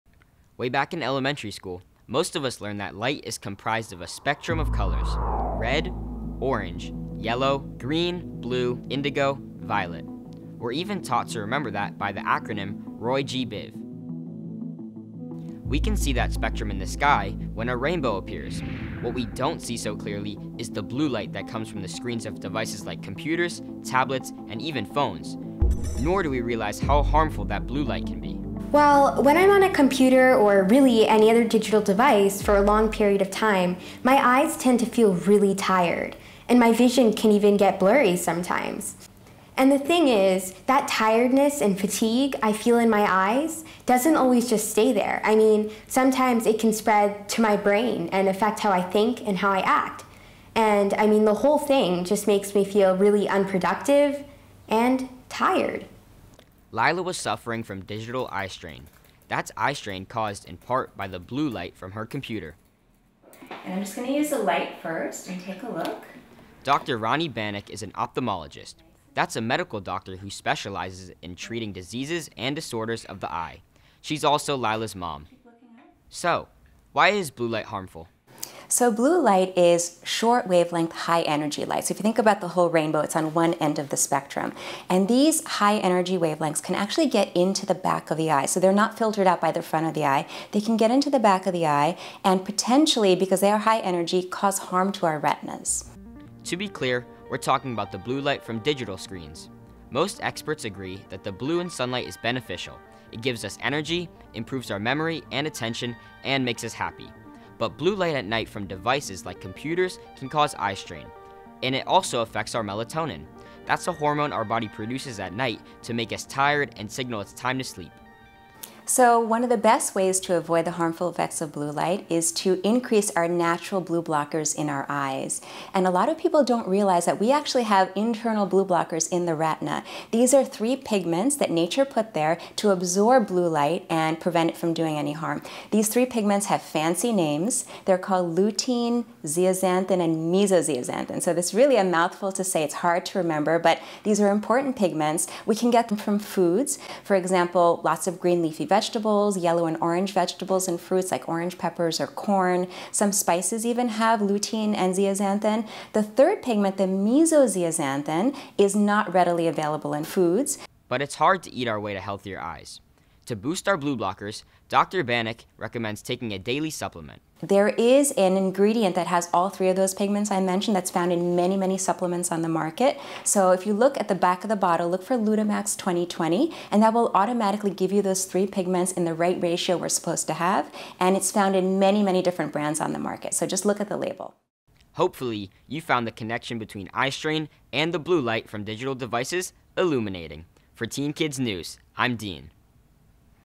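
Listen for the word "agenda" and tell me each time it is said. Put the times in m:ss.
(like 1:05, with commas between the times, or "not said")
not said.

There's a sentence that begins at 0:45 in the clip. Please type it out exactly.
I mean, sometimes it can spread to my brain and affect how I think and how I act.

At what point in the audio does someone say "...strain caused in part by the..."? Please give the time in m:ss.
0:59.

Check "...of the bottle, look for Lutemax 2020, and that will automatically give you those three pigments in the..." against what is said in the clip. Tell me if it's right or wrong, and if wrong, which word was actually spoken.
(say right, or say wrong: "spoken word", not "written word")
right.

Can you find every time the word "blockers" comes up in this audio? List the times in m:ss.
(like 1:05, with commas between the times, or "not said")
2:04, 2:08, 2:43.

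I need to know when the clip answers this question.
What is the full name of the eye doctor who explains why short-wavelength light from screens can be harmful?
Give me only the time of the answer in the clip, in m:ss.
1:06.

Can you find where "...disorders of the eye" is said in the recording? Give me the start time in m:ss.
1:12.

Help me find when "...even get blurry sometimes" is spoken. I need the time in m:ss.
0:37.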